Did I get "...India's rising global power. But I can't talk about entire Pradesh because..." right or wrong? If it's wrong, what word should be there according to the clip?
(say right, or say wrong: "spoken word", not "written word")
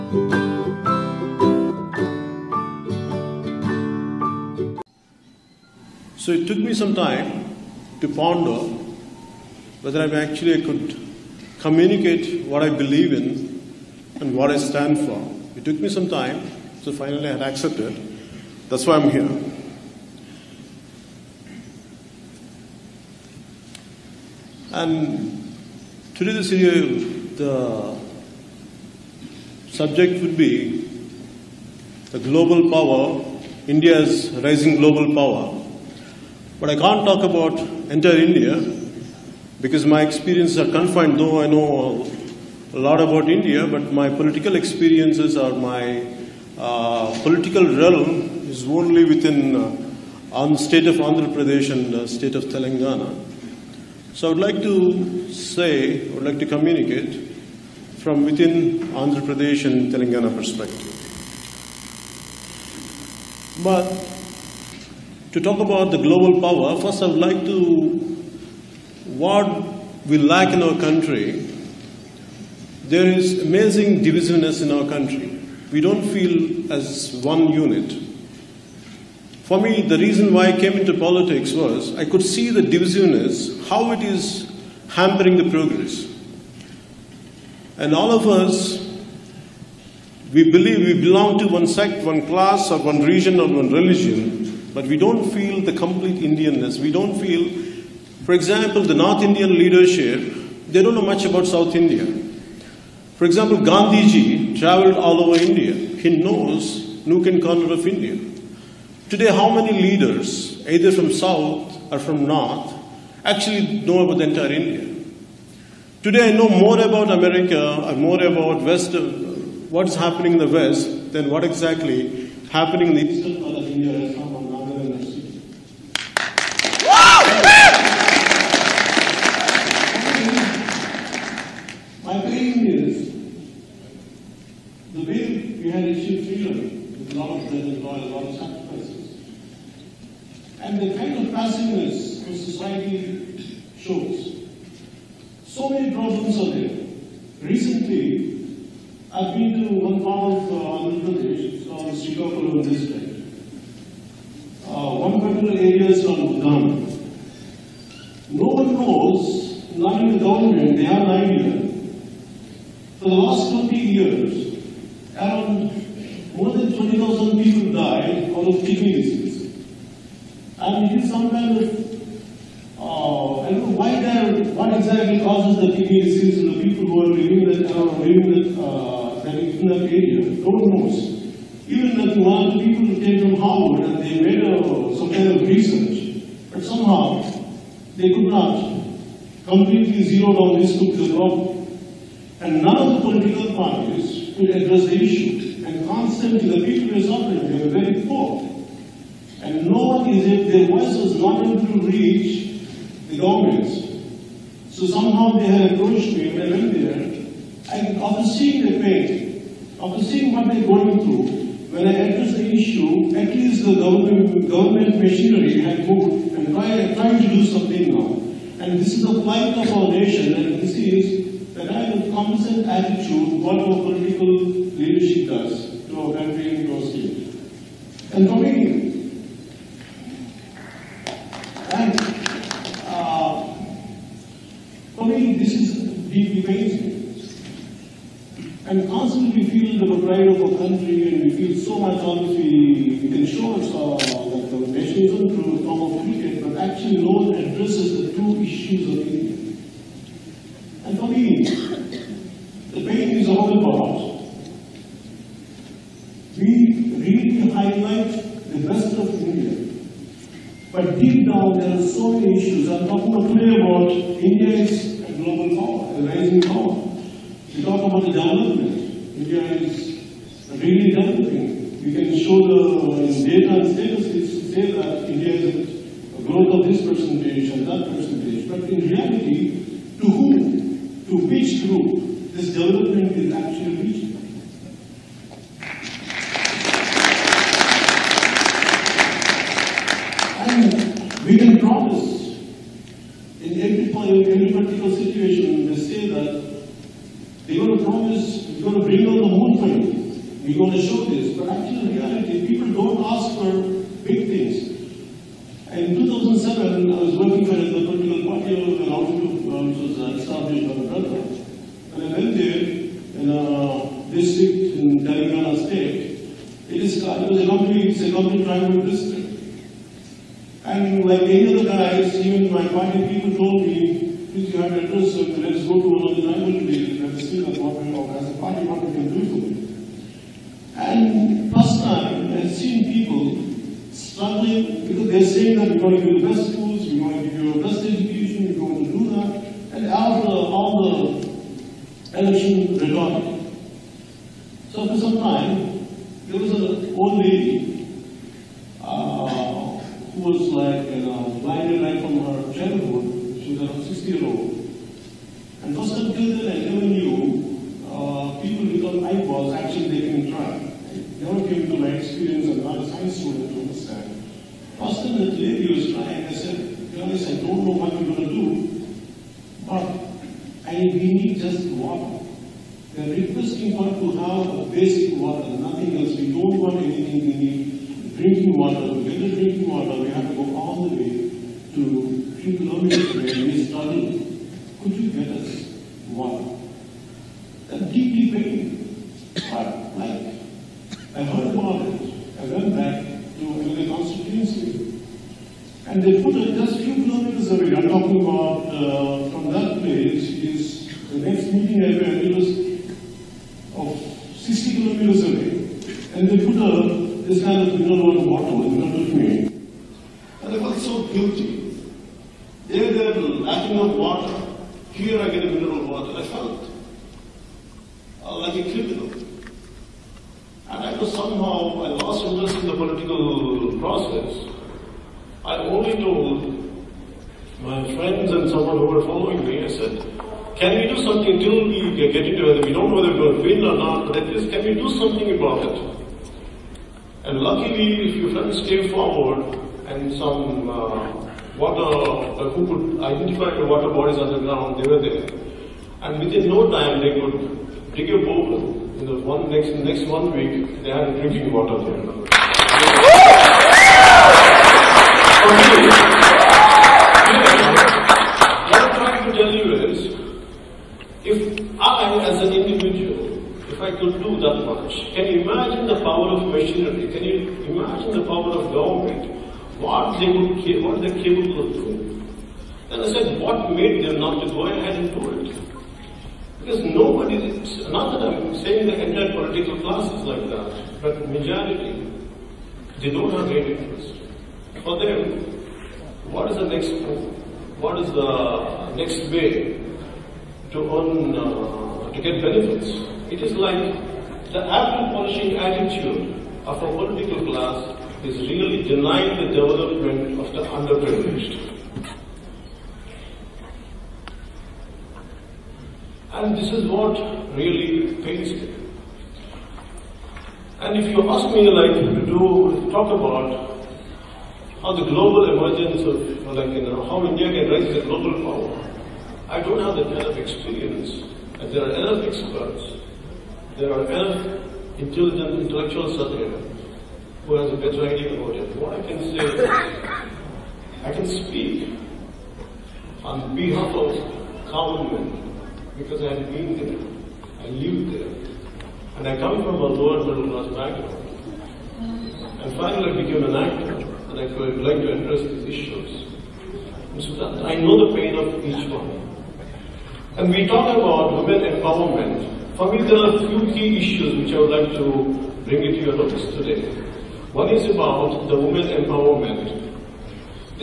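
wrong: "India", not "Pradesh".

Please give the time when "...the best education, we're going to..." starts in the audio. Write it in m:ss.
5:37.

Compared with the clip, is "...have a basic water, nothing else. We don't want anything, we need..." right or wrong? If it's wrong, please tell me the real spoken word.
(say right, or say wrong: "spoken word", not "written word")
right.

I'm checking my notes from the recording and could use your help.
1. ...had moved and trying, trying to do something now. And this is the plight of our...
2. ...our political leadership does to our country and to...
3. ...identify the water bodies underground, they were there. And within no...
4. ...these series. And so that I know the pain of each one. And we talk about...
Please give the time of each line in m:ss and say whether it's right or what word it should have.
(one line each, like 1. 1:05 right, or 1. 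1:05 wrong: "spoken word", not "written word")
1. 3:35 right
2. 3:43 right
3. 7:23 right
4. 9:05 wrong: "issues", not "series".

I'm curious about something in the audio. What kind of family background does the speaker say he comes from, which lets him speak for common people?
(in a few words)
lower middle class.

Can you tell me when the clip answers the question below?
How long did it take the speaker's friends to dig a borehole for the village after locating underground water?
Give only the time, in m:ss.
7:30.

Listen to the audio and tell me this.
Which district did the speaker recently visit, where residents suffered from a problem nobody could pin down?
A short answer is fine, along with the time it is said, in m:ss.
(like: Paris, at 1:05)
Srikakulam, at 2:32.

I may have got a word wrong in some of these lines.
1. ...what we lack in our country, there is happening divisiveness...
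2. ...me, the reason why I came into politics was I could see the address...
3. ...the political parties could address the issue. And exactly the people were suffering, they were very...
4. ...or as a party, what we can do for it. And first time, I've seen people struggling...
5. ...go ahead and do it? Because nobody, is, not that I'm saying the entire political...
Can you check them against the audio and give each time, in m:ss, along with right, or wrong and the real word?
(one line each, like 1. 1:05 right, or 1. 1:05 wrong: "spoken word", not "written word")
1. 1:09 wrong: "amazing", not "happening"
2. 1:19 wrong: "divisiveness", not "address"
3. 3:12 wrong: "constantly", not "exactly"
4. 5:27 right
5. 7:54 right.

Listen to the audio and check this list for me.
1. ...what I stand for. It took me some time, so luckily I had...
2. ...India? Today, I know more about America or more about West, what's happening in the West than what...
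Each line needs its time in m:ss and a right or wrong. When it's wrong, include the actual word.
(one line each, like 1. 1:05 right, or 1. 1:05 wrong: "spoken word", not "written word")
1. 0:14 wrong: "finally", not "luckily"
2. 1:54 right.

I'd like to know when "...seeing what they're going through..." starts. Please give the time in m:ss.
3:30.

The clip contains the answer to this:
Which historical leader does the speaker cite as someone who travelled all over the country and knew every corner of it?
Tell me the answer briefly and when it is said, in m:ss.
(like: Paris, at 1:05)
Gandhiji, at 1:43.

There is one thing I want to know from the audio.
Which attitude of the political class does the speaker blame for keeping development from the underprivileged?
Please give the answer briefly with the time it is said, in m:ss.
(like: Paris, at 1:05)
apple polishing, at 8:14.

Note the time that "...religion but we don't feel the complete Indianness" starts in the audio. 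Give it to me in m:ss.
1:33.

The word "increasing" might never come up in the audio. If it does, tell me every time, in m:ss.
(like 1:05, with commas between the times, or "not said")
not said.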